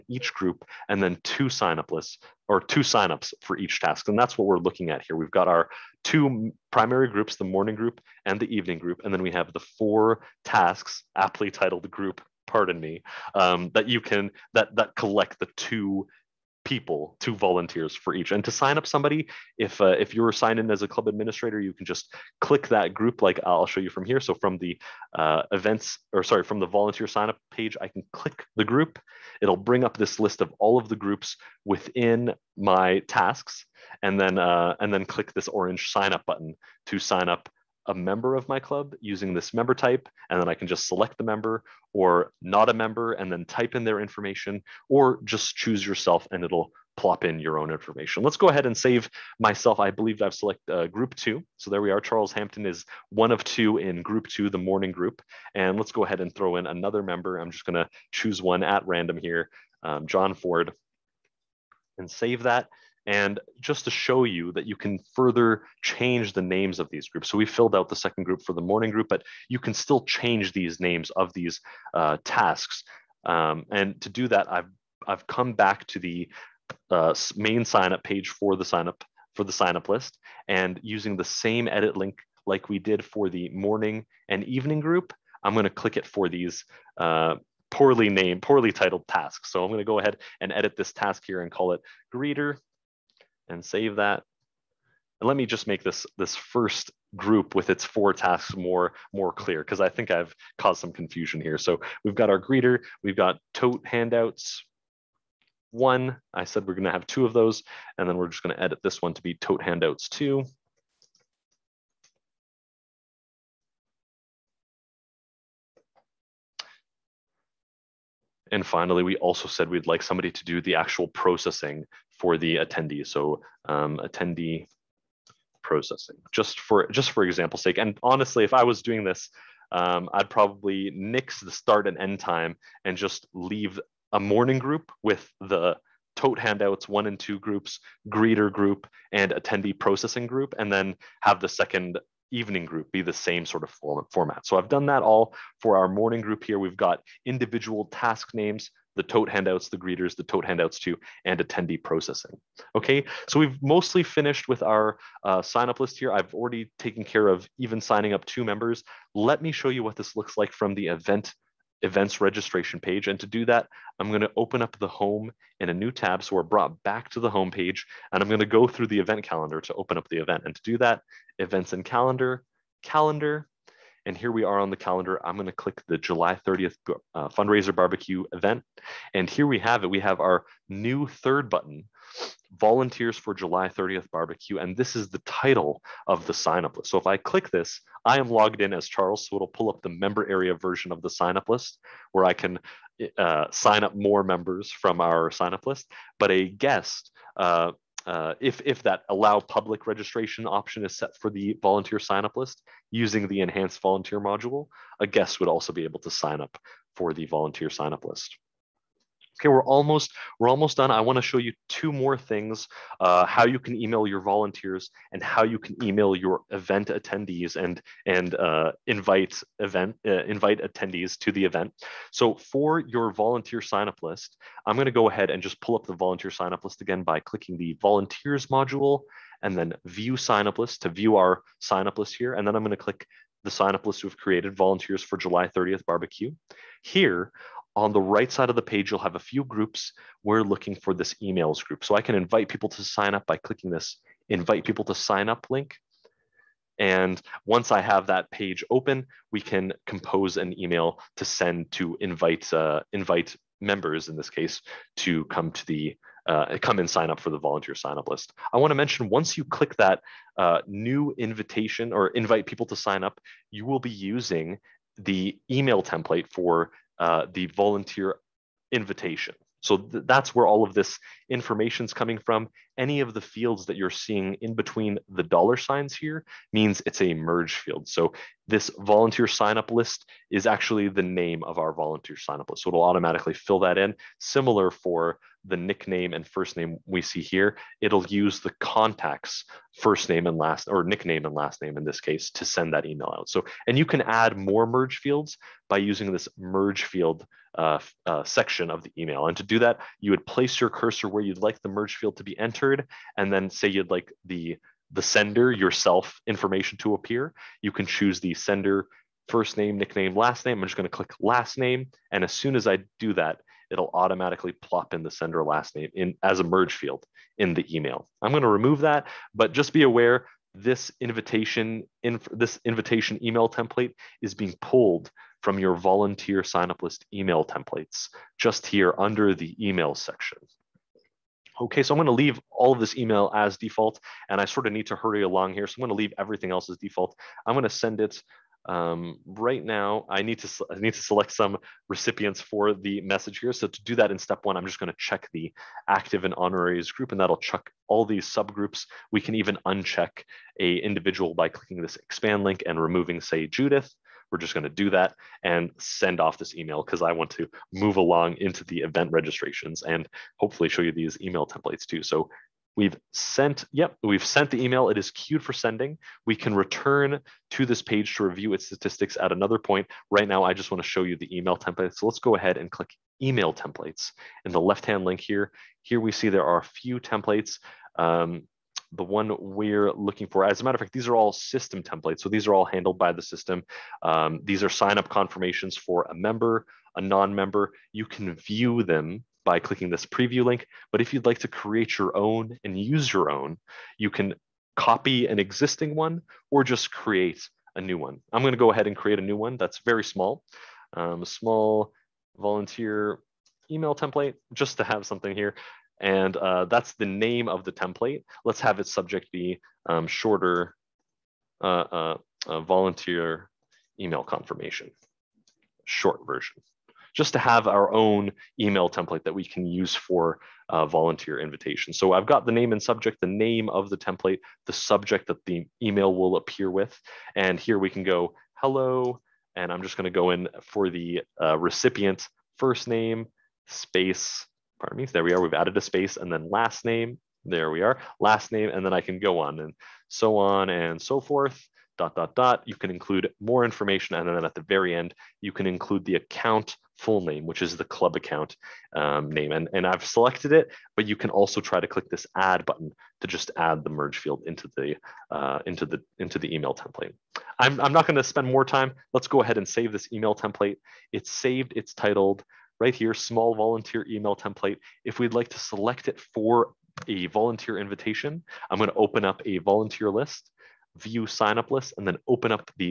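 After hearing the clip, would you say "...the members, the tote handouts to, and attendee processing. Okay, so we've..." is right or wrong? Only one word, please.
wrong.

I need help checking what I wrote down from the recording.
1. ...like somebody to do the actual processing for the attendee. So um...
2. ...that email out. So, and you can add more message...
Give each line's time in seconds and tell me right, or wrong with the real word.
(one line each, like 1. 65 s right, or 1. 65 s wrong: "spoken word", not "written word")
1. 119 s right
2. 292 s wrong: "merge", not "message".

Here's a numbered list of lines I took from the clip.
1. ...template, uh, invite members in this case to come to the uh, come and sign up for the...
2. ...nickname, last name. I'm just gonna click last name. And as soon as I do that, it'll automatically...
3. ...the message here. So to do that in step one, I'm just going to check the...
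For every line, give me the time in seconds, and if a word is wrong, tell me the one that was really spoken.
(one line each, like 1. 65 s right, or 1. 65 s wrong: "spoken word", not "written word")
1. 252 s wrong: "invite", not "template"
2. 309 s right
3. 342 s right.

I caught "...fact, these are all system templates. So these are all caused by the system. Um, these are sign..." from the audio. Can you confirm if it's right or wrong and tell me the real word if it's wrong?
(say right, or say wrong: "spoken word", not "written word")
wrong: "handled", not "caused".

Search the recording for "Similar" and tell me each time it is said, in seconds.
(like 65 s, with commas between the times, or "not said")
284 s.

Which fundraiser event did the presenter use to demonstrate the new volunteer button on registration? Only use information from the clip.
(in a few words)
Fundraiser barbecue.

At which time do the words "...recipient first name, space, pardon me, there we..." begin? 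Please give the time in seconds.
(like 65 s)
431 s.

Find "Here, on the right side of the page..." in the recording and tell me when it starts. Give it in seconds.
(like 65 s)
236 s.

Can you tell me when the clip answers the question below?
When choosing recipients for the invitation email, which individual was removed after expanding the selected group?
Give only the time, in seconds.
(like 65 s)
353 s.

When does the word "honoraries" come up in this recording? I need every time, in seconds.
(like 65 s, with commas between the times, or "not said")
346 s.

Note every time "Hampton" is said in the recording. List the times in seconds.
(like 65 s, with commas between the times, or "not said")
52 s.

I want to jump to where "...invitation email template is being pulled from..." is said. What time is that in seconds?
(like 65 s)
322 s.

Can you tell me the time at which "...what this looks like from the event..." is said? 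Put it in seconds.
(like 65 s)
159 s.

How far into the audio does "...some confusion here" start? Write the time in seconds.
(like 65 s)
100 s.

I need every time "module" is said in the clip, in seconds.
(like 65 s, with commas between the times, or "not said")
204 s, 228 s.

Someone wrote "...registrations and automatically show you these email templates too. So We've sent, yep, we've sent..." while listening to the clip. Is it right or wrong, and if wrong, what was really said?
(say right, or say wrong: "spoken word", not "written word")
wrong: "hopefully", not "automatically".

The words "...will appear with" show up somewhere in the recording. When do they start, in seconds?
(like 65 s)
426 s.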